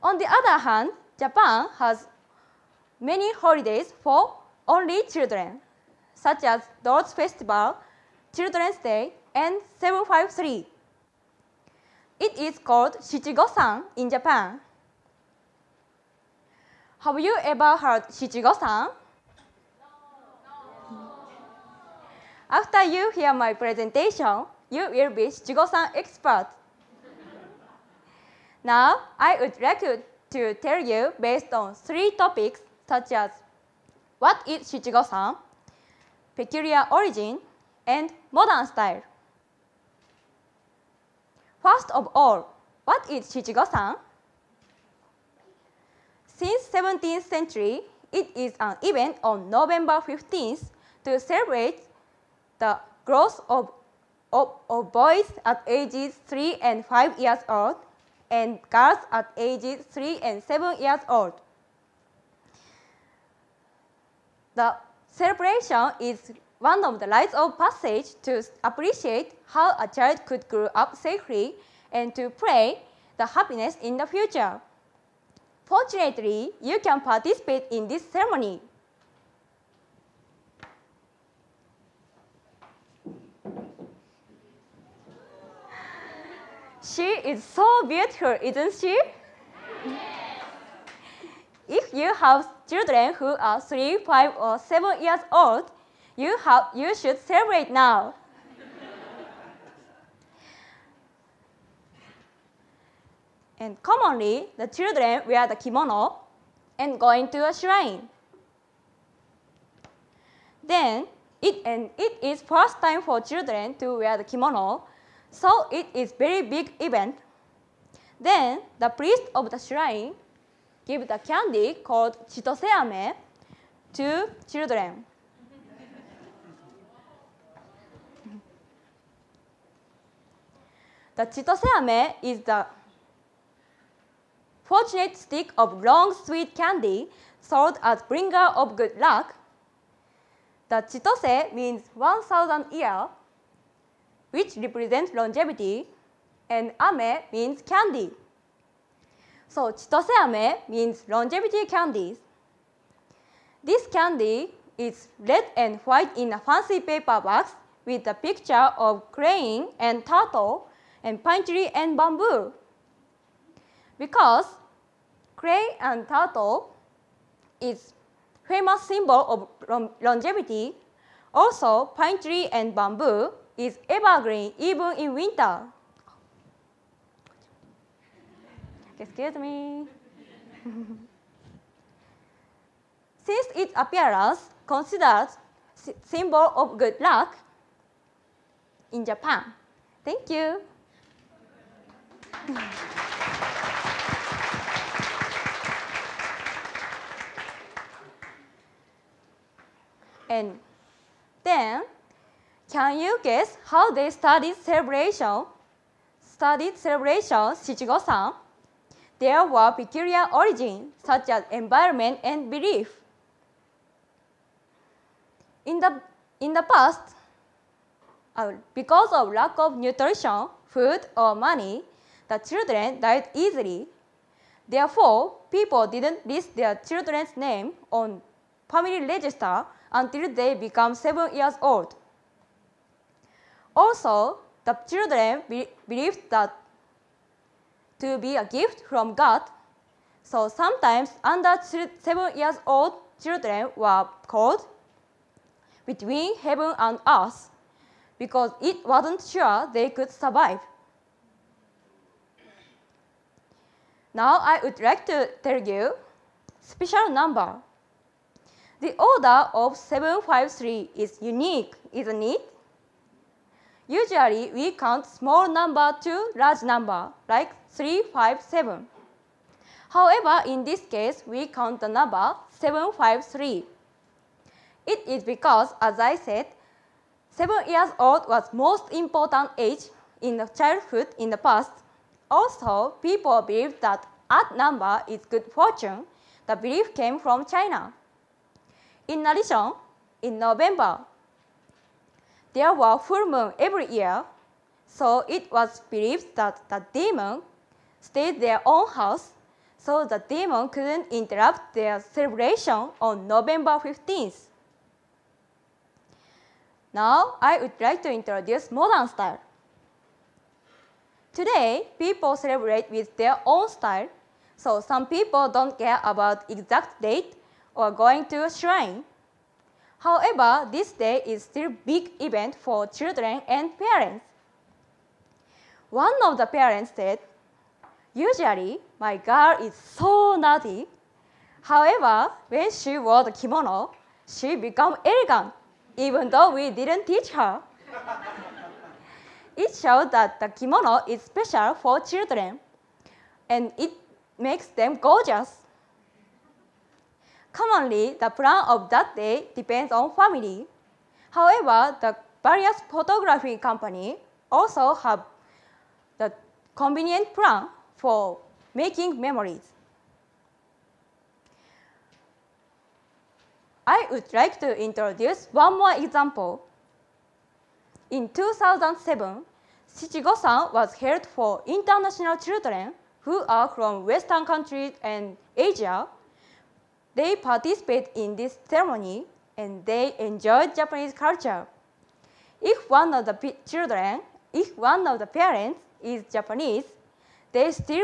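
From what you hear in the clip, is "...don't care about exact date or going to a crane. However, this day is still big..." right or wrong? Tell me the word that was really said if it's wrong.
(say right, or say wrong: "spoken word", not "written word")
wrong: "shrine", not "crane".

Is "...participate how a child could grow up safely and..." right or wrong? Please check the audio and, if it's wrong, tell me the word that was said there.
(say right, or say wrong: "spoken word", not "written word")
wrong: "appreciate", not "participate".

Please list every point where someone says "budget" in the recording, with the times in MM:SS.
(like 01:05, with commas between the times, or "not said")
not said.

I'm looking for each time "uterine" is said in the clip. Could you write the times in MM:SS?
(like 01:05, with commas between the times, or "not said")
not said.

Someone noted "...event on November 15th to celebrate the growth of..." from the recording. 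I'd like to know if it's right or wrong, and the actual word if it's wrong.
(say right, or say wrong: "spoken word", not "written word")
right.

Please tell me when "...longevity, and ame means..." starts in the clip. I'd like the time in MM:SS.
02:25.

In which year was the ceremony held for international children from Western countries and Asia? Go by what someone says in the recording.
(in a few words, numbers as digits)
2007.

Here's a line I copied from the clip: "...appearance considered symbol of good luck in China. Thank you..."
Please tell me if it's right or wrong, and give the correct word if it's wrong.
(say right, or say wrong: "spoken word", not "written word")
wrong: "Japan", not "China".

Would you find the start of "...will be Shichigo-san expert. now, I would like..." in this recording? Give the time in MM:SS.
00:24.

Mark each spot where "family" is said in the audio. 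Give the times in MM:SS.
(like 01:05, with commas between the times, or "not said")
03:48, 05:50.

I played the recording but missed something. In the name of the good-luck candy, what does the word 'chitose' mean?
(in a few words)
1,000 year.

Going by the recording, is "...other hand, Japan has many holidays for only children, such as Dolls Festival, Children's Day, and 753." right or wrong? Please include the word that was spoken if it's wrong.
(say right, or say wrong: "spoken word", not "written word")
right.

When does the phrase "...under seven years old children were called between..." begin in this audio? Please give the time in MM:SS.
04:01.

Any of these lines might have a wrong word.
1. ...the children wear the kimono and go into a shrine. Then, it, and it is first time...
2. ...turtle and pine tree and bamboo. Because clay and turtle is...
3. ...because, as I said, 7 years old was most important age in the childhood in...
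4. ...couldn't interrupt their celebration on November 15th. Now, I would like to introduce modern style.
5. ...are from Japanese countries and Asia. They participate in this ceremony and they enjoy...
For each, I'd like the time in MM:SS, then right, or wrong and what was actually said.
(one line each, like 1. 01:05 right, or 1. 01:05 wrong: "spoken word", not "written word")
1. 01:44 right
2. 02:40 right
3. 04:35 right
4. 05:00 right
5. 06:13 wrong: "Western", not "Japanese".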